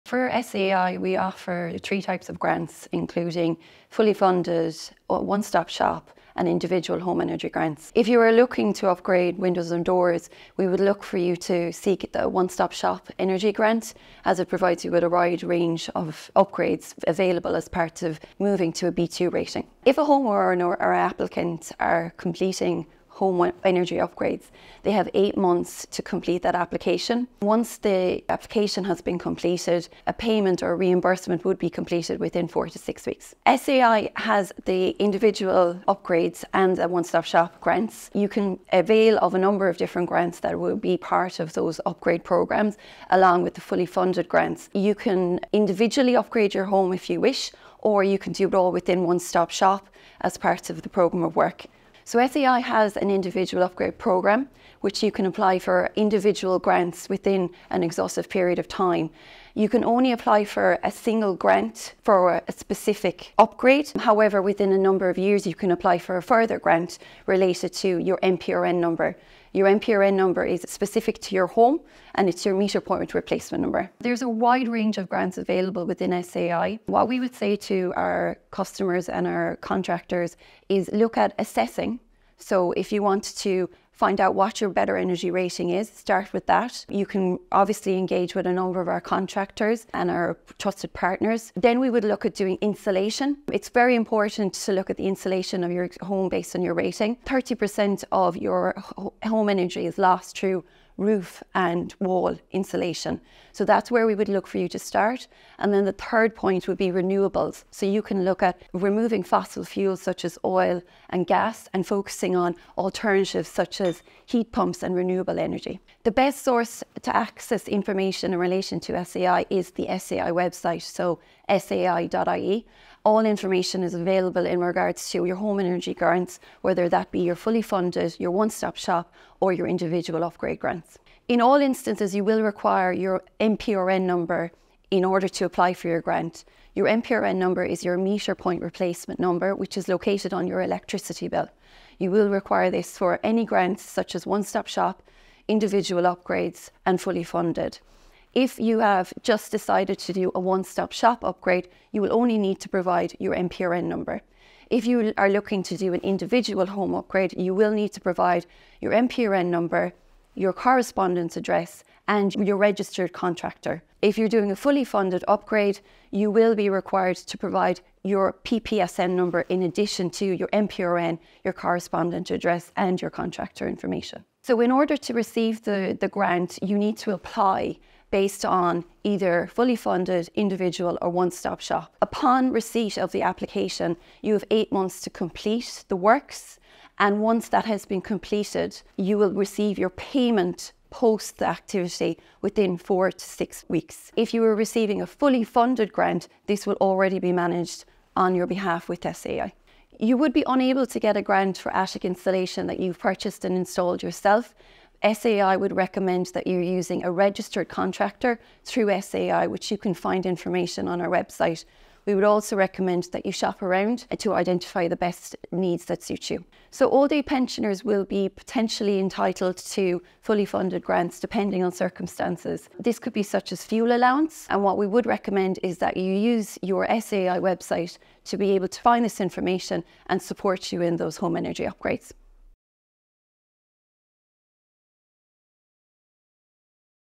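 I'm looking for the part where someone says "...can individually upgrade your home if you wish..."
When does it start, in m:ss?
0:44.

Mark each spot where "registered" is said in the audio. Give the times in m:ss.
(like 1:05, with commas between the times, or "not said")
2:42, 3:27.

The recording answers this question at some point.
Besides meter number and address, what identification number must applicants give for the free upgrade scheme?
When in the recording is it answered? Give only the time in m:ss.
2:48.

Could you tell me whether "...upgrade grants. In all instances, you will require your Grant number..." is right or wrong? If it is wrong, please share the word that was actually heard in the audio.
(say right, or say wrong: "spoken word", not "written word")
wrong: "MPRN", not "Grant".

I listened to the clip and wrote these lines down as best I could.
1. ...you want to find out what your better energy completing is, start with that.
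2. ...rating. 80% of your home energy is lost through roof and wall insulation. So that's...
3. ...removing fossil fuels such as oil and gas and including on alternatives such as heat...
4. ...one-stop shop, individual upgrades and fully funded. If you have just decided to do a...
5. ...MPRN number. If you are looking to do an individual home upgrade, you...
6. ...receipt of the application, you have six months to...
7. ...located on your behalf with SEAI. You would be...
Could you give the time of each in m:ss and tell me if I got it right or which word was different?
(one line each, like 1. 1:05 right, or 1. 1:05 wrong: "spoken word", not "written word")
1. 1:22 wrong: "rating", not "completing"
2. 1:36 wrong: "30", not "80"
3. 1:48 wrong: "focusing", not "including"
4. 2:24 right
5. 2:33 right
6. 3:02 wrong: "eight", not "six"
7. 3:17 wrong: "managed", not "located".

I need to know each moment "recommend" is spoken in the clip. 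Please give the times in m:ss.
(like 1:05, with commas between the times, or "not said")
3:25, 3:32, 3:45.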